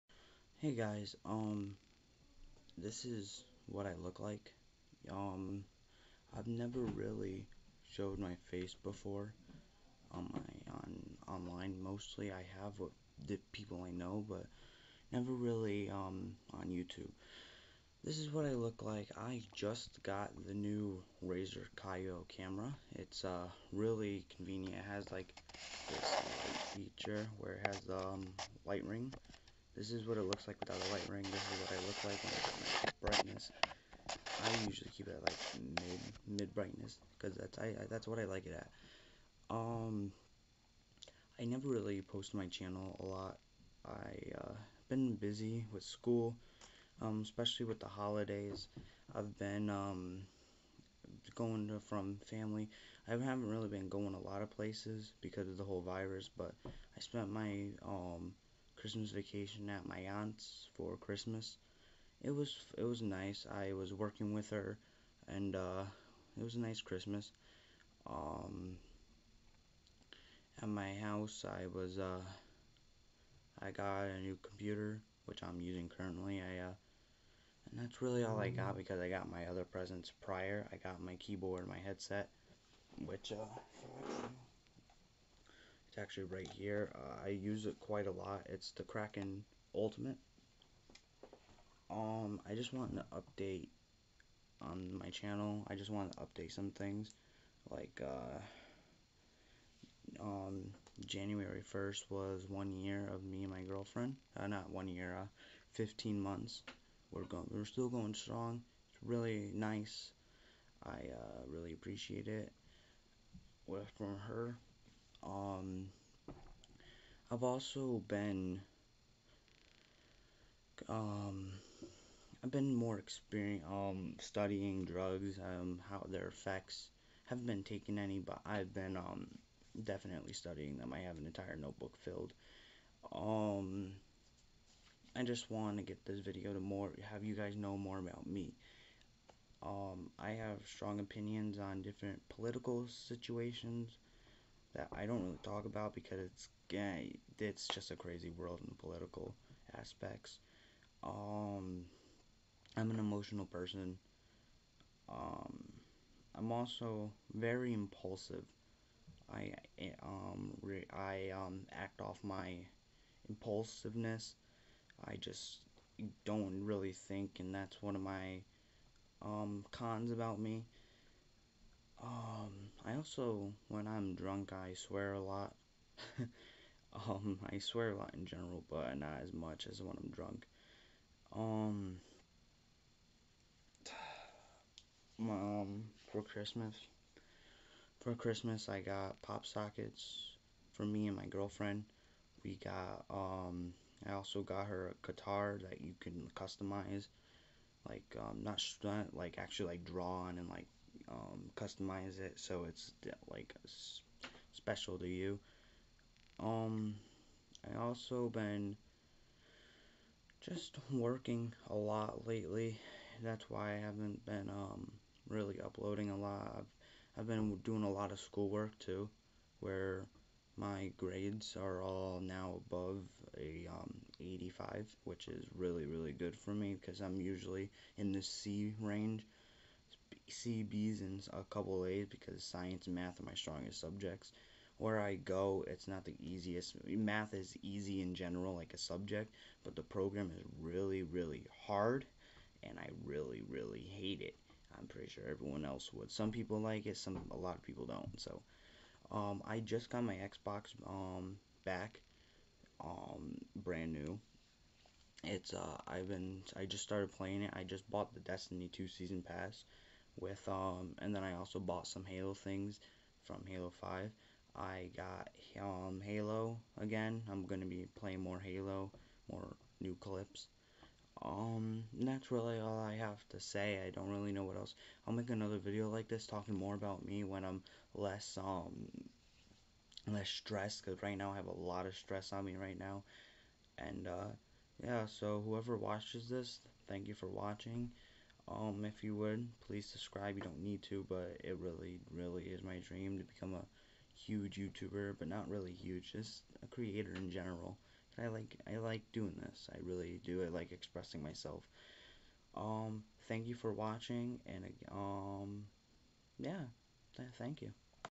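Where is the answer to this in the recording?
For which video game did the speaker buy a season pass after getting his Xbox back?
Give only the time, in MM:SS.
04:18.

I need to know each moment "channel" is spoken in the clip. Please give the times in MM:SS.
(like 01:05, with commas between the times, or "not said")
00:42, 01:35.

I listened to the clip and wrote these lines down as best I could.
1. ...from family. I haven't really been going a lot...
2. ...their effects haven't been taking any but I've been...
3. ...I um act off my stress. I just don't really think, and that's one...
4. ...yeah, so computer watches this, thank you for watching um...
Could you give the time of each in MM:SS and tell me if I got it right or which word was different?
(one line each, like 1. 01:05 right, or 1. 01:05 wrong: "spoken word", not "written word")
1. 00:51 right
2. 02:06 right
3. 02:40 wrong: "impulsiveness", not "stress"
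4. 04:44 wrong: "whoever", not "computer".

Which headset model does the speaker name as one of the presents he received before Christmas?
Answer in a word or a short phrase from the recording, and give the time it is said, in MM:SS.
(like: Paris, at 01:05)
Kraken Ultimate, at 01:28.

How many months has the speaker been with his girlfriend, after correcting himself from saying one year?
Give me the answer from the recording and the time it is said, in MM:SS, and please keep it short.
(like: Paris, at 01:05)
15 months, at 01:45.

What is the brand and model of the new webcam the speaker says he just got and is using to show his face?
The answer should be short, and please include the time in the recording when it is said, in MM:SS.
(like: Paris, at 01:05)
Razer Kiyo, at 00:21.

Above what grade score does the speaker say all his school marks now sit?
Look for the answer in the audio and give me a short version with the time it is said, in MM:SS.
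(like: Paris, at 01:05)
85, at 03:44.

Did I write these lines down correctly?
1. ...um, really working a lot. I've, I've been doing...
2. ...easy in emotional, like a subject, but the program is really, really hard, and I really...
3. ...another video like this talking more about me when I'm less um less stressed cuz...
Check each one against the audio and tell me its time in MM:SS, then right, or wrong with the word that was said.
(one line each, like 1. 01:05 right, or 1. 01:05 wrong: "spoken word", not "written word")
1. 03:34 wrong: "uploading", not "working"
2. 03:57 wrong: "general", not "emotional"
3. 04:35 right.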